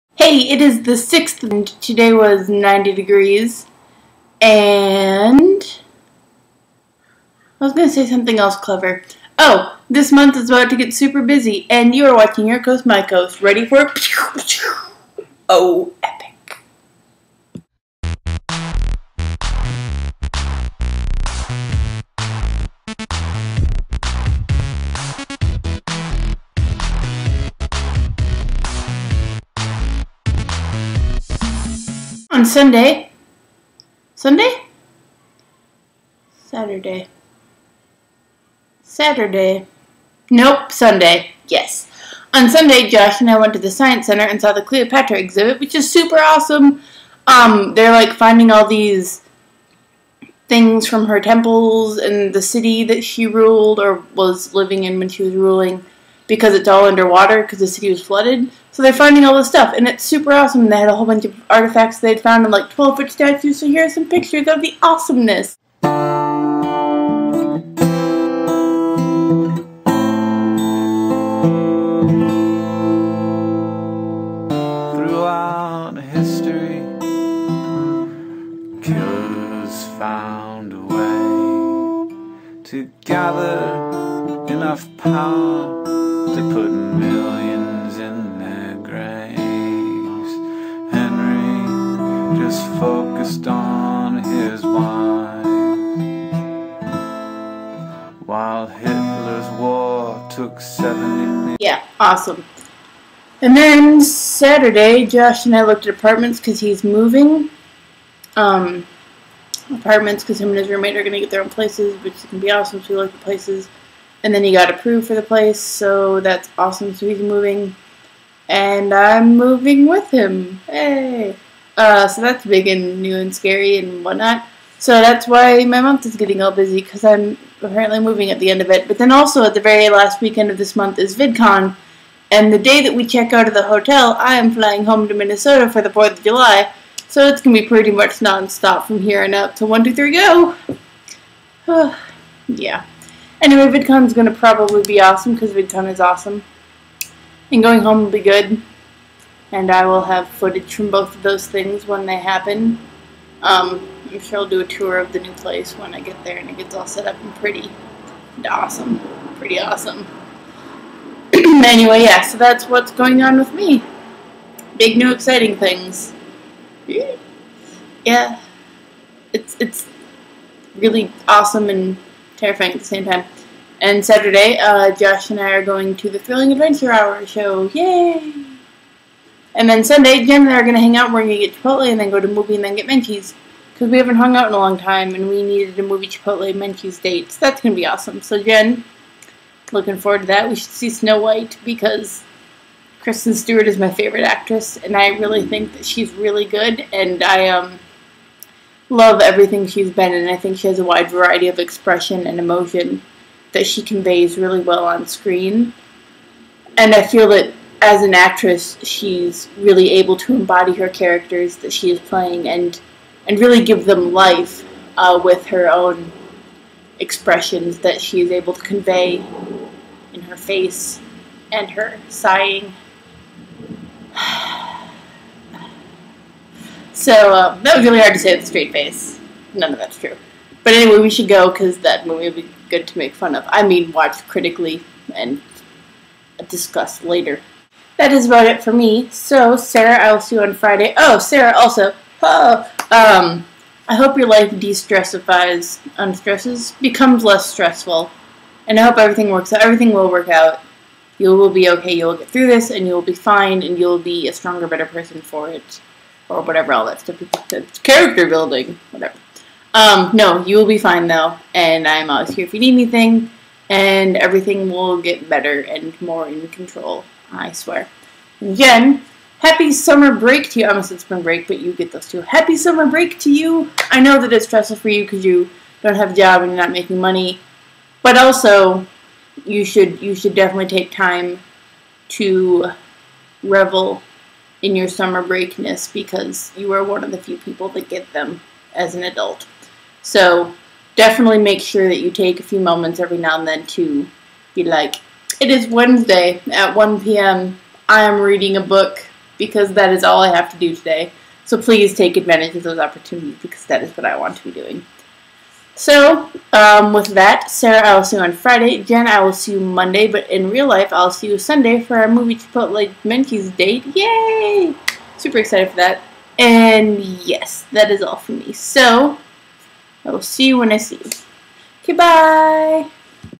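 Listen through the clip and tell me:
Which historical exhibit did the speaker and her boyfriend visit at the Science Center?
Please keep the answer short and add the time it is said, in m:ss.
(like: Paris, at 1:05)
Cleopatra, at 0:44.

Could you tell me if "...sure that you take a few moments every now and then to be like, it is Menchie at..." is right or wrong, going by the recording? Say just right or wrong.
wrong.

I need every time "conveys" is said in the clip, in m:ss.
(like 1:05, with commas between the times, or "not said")
3:23, 3:38.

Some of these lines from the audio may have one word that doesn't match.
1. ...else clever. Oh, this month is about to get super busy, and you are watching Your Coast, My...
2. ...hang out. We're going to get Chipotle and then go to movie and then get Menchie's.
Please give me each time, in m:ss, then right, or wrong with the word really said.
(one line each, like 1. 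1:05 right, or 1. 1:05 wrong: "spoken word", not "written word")
1. 0:08 right
2. 3:00 right.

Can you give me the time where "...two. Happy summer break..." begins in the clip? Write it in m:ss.
4:32.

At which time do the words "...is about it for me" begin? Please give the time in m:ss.
3:58.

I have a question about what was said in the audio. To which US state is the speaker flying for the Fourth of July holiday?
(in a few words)
Minnesota.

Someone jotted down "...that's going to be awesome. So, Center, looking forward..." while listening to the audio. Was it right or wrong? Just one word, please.
wrong.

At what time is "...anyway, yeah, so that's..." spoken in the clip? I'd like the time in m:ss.
2:41.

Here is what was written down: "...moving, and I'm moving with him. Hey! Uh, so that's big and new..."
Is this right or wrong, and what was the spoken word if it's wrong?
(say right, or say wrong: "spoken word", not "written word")
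right.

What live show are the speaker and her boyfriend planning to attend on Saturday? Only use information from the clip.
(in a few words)
Thrilling Adventure Hour.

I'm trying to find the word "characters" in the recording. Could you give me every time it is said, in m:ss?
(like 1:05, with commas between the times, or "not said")
3:30, 4:17.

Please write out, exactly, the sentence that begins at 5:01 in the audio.
So please take advantage of those opportunities because that is what I want to be doing.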